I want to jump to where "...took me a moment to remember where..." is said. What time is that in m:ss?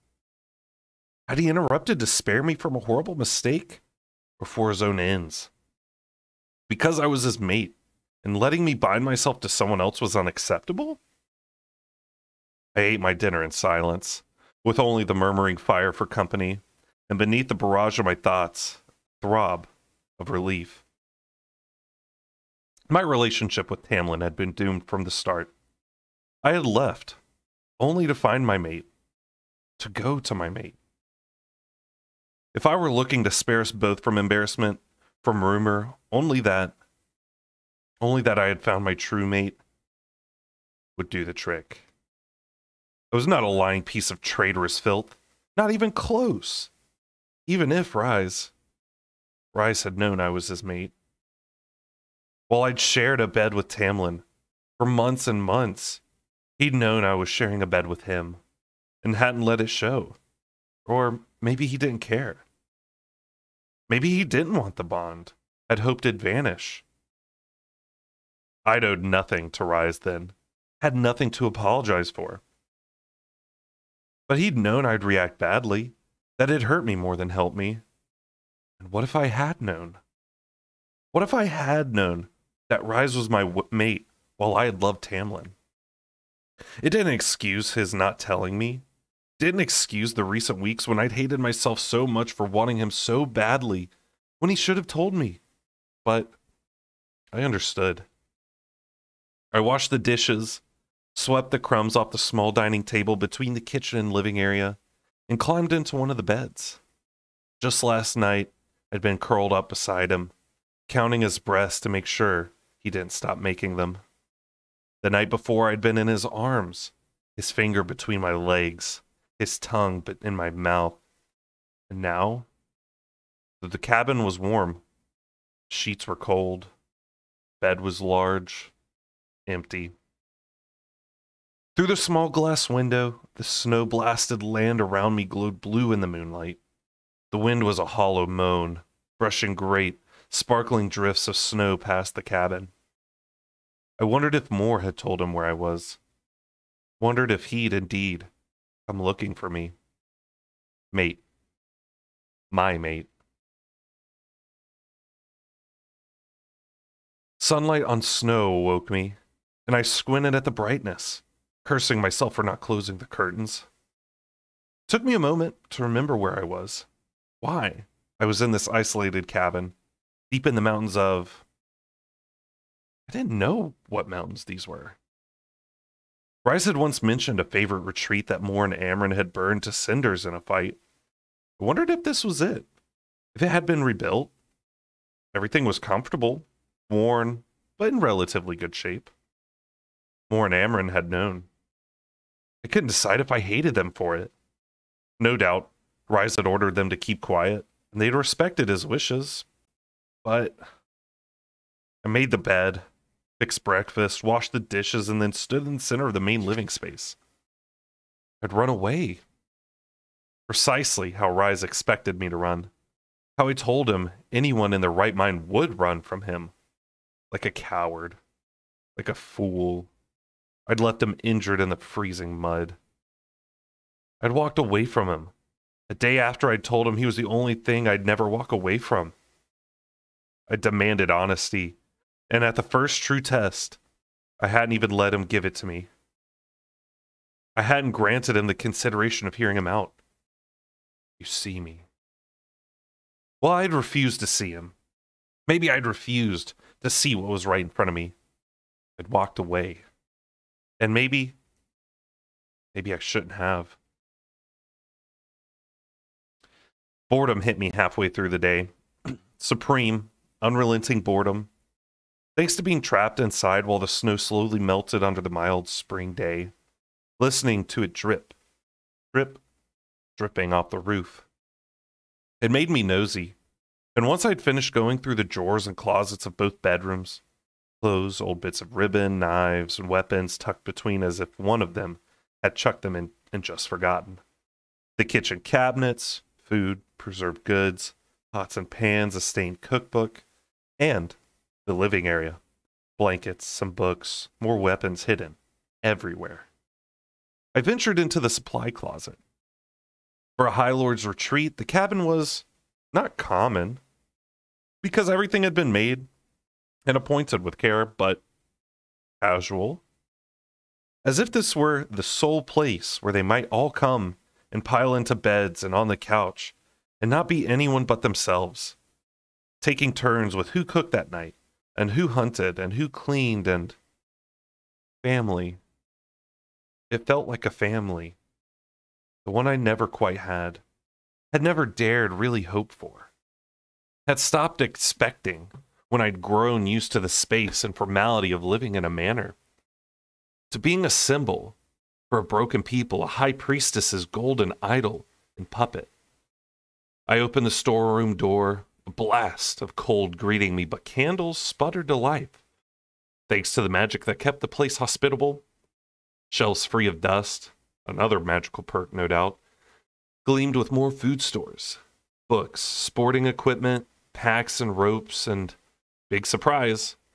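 2:44.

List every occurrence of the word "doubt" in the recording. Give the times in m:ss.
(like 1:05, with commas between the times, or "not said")
3:15, 5:59.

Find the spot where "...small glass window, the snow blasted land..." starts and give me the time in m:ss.
2:11.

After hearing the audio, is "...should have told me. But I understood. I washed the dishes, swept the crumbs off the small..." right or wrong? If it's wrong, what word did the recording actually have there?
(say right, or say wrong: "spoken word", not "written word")
right.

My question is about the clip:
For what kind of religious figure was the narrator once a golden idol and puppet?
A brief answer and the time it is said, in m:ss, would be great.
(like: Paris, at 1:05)
A high priestess, at 5:43.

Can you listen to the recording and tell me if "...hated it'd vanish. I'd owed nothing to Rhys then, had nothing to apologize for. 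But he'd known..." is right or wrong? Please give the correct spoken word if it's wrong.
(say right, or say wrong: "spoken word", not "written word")
wrong: "hoped", not "hated".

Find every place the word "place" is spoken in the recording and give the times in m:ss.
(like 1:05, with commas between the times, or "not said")
5:12, 5:54.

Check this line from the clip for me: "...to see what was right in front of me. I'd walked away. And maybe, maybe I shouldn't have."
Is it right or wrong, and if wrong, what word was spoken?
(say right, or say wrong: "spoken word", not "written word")
right.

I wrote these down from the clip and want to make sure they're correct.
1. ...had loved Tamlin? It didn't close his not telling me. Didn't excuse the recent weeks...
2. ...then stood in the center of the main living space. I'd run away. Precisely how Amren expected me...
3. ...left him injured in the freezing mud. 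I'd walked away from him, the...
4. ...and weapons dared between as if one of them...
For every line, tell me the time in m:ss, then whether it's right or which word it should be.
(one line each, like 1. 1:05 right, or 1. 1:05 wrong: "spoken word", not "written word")
1. 1:24 wrong: "excuse", not "close"
2. 3:25 wrong: "Rhys", not "Amren"
3. 3:40 right
4. 4:39 wrong: "tucked", not "dared".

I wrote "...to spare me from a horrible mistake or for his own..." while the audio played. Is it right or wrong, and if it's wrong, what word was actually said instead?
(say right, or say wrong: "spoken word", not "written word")
right.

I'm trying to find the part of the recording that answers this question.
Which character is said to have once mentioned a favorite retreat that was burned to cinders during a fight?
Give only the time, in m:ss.
2:56.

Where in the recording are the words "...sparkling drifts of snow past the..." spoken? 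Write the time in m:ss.
2:20.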